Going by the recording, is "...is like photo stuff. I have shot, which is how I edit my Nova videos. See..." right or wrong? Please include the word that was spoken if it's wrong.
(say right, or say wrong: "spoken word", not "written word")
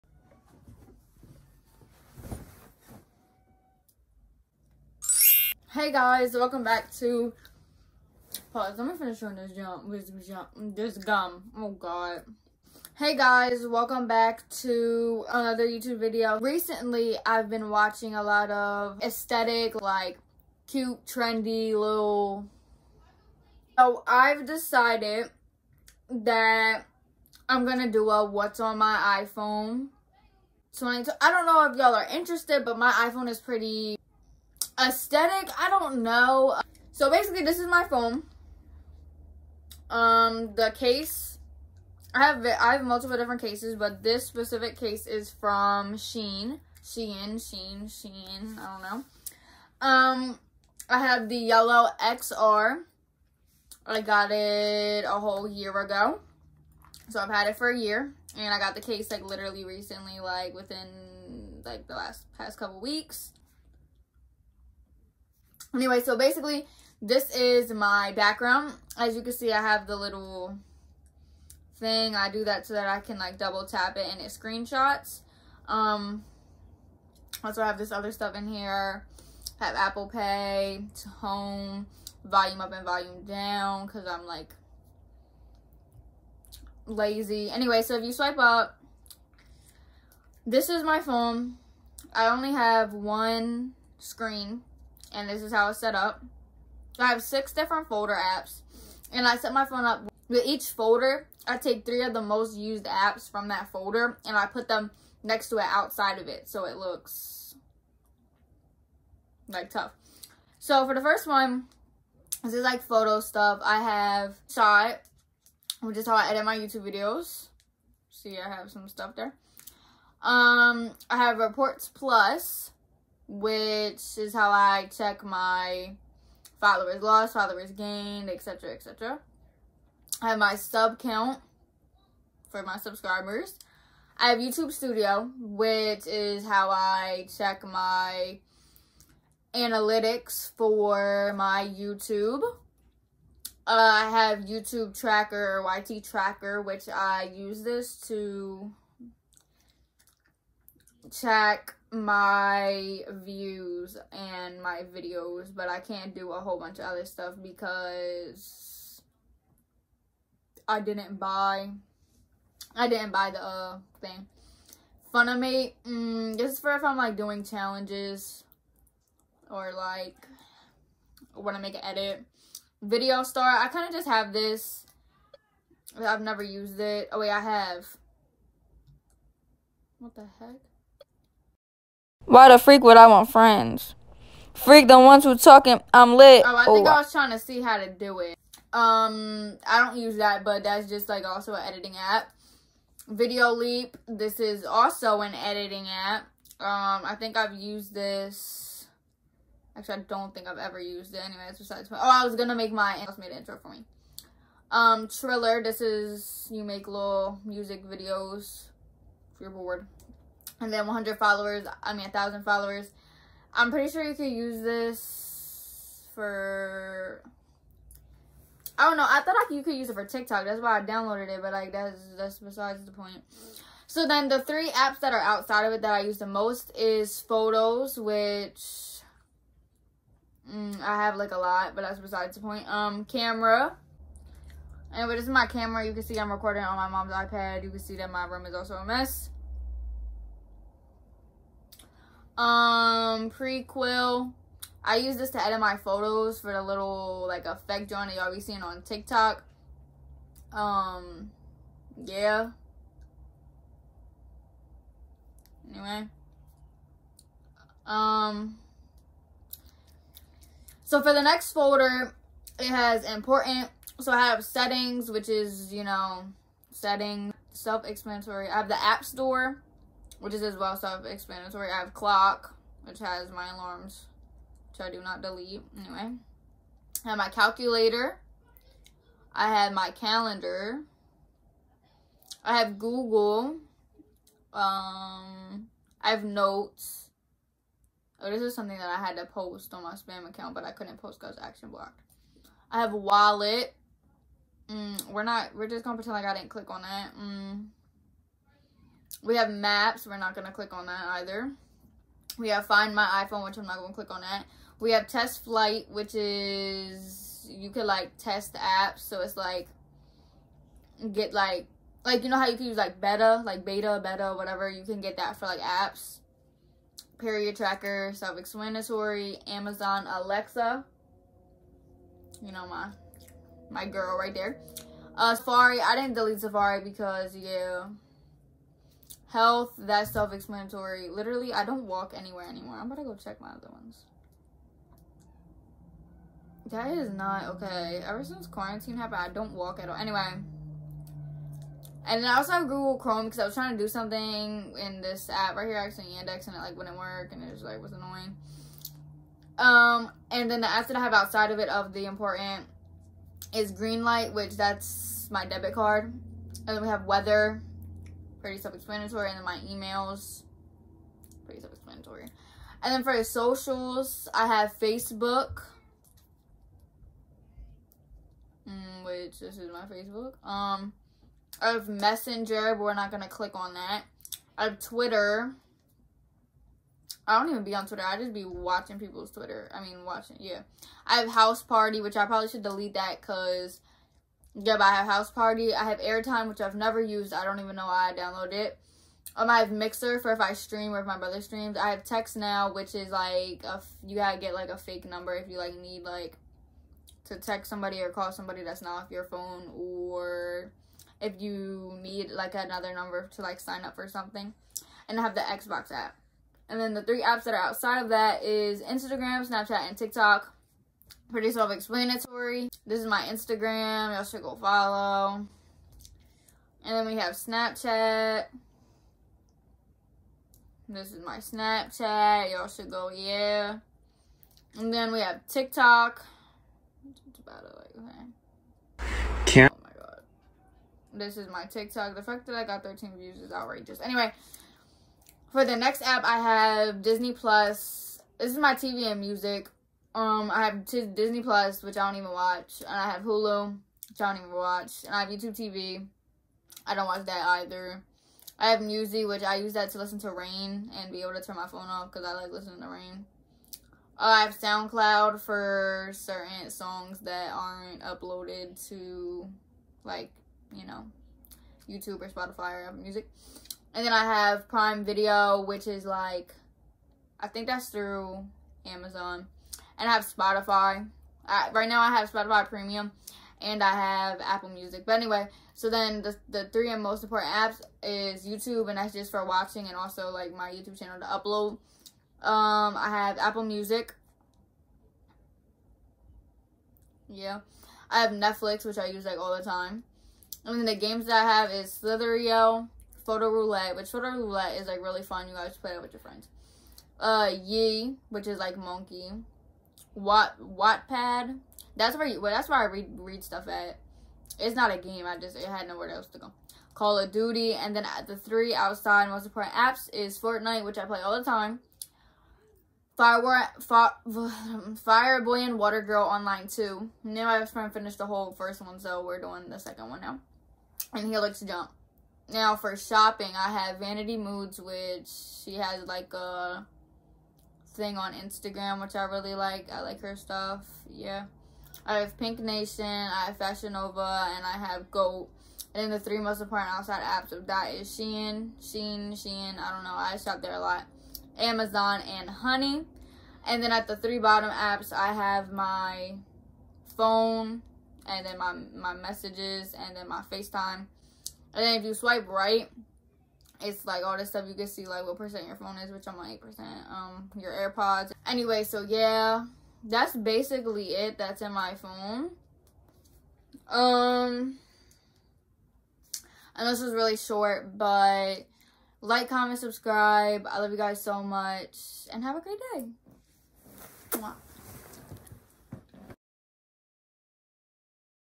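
wrong: "YouTube", not "Nova".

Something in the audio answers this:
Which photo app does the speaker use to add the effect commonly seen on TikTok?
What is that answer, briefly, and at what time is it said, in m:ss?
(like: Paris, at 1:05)
Prequel, at 4:03.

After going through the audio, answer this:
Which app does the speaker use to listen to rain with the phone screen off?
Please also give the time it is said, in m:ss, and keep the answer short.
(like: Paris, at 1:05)
Musi, at 7:28.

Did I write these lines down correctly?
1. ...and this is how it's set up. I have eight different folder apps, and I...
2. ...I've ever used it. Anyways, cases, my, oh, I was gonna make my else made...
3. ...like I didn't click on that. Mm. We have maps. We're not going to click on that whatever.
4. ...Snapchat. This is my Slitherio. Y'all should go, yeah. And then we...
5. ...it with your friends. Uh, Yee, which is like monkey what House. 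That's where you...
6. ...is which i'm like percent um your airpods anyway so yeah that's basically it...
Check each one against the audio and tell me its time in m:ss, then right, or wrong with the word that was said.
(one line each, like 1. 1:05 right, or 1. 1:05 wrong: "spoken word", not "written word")
1. 1:35 wrong: "six", not "eight"
2. 3:20 wrong: "besides", not "cases"
3. 4:56 wrong: "either", not "whatever"
4. 6:57 wrong: "Snapchat", not "Slitherio"
5. 8:15 wrong: "Wattpad", not "House"
6. 9:15 right.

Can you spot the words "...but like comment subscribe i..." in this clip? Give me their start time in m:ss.
9:27.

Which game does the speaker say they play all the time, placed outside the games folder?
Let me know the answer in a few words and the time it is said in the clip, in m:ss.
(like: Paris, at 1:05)
Fortnite, at 8:30.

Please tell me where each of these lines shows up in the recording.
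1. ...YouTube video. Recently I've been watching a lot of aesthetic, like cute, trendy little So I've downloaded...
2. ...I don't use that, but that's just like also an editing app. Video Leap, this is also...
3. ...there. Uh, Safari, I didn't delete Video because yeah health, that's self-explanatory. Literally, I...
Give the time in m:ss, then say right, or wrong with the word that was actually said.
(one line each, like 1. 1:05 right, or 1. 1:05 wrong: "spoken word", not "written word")
1. 0:15 wrong: "decided", not "downloaded"
2. 3:09 right
3. 5:24 wrong: "Safari", not "Video".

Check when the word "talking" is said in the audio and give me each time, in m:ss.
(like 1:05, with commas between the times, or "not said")
3:05.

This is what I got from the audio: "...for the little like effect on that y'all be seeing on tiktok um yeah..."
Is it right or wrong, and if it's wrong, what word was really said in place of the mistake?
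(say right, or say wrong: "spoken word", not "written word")
right.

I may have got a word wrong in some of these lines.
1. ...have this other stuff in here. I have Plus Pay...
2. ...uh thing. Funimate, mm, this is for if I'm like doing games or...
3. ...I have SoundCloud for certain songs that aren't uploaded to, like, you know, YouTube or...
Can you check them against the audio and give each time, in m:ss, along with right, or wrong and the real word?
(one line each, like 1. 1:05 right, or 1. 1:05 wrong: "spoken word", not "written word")
1. 1:17 wrong: "Apple", not "Plus"
2. 2:43 wrong: "challenges", not "games"
3. 7:34 right.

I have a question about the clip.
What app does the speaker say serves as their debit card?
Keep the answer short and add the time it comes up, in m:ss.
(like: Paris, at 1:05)
Greenlight, at 5:53.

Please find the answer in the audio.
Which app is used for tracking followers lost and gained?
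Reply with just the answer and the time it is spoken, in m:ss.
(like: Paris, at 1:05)
Reports Plus, at 2:01.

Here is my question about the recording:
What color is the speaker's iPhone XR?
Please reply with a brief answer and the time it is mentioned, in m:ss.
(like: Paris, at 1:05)
Yellow, at 0:51.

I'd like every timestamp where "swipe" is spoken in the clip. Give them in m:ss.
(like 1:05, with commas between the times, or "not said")
1:28, 9:12.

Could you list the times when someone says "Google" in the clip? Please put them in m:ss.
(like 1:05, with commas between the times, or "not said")
4:42, 5:42.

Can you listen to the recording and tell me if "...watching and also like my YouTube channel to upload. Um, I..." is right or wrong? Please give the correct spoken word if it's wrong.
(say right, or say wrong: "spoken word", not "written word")
right.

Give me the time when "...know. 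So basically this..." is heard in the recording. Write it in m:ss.
0:36.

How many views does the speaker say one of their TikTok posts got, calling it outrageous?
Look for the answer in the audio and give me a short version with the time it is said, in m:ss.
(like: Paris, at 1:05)
13, at 7:12.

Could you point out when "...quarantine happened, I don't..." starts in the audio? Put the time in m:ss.
5:38.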